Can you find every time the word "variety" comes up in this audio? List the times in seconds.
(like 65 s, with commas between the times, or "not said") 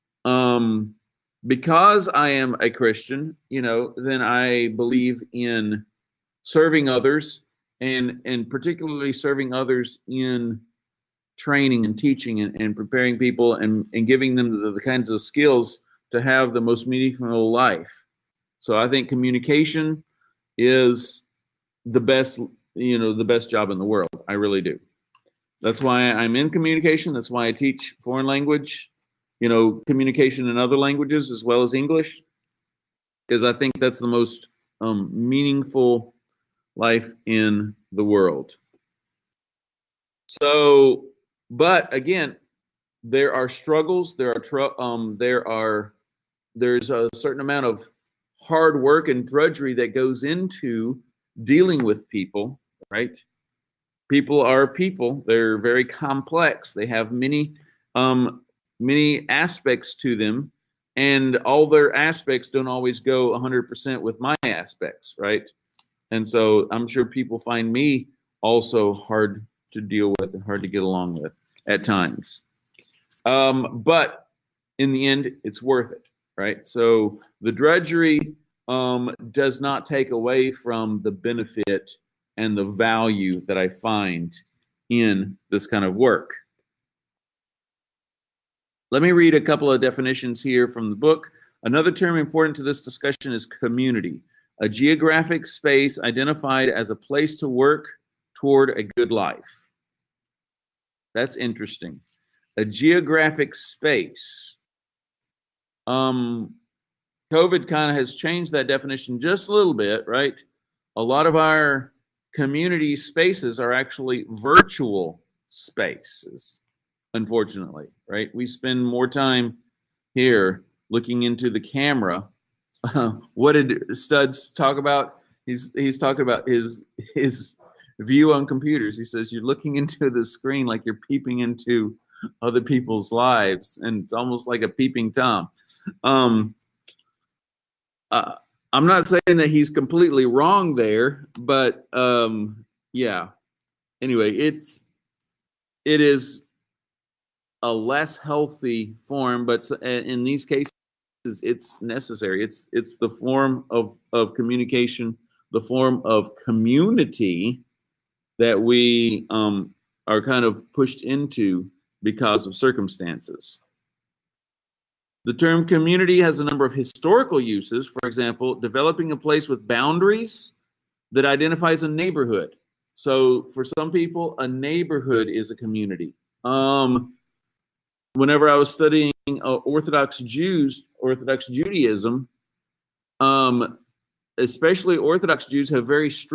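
not said.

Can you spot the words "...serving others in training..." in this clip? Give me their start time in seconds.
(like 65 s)
9 s.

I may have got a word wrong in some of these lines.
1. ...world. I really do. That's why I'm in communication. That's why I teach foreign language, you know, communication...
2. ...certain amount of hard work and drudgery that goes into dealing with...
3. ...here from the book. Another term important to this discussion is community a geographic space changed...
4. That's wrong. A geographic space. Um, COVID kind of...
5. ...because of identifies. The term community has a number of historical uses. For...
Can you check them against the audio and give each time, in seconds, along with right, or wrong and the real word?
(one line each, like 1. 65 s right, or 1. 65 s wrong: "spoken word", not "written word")
1. 23 s right
2. 47 s right
3. 90 s wrong: "identified", not "changed"
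4. 101 s wrong: "interesting", not "wrong"
5. 162 s wrong: "circumstances", not "identifies".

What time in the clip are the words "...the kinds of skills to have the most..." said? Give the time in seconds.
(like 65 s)
14 s.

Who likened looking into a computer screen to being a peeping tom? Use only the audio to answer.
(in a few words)
Studs.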